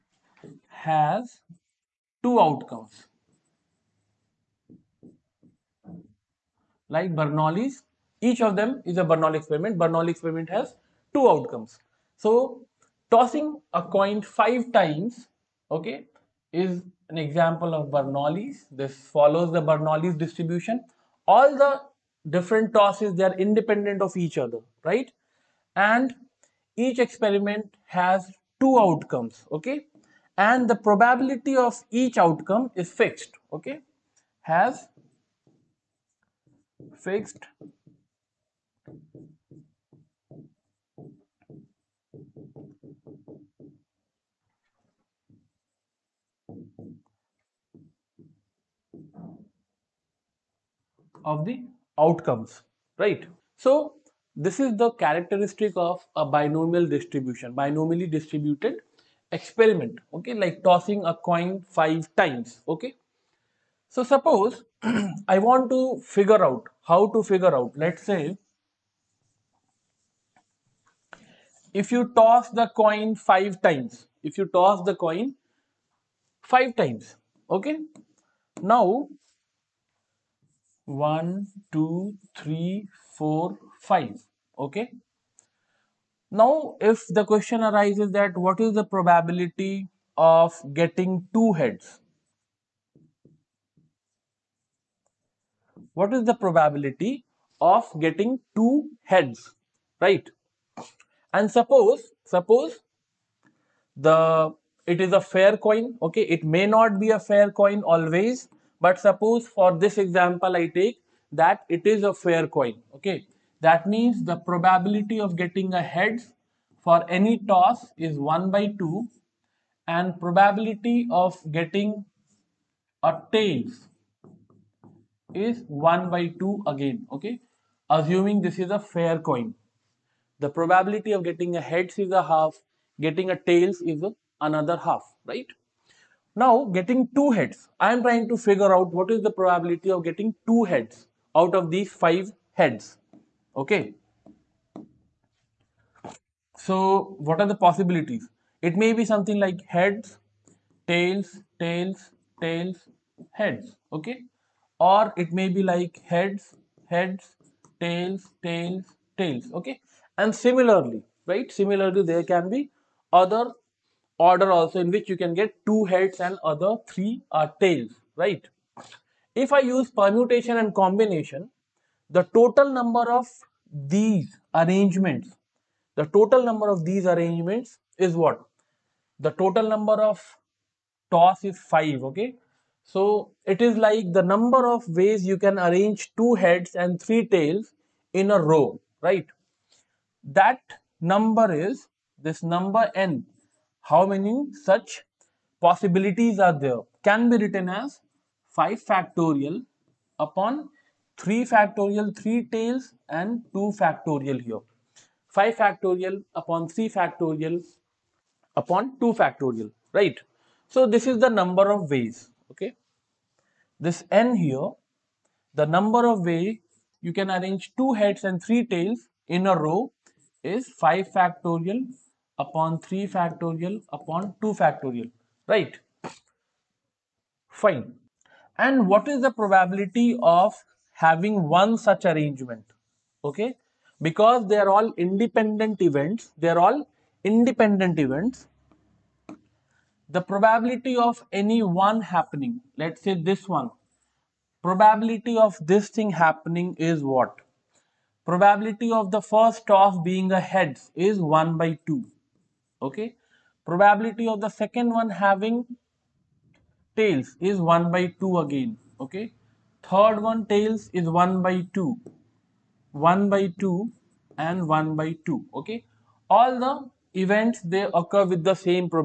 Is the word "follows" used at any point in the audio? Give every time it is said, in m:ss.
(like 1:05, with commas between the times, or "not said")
0:19.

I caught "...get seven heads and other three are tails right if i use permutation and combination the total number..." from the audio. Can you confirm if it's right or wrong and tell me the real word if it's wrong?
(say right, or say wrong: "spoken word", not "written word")
wrong: "two", not "seven".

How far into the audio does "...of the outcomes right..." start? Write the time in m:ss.
0:51.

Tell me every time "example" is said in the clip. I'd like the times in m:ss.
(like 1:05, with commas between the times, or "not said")
0:17, 1:49.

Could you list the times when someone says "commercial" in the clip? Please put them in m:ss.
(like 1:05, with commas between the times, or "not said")
not said.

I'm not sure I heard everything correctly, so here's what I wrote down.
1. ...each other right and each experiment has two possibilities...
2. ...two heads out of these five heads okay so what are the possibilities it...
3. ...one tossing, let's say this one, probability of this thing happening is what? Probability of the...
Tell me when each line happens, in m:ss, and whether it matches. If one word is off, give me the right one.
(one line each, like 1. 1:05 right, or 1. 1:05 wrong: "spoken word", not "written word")
1. 0:24 wrong: "outcomes", not "possibilities"
2. 2:20 right
3. 4:01 wrong: "happening", not "tossing".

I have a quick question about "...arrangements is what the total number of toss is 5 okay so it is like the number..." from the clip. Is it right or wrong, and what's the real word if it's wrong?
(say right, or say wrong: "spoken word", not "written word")
right.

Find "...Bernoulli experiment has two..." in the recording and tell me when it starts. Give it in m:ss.
0:09.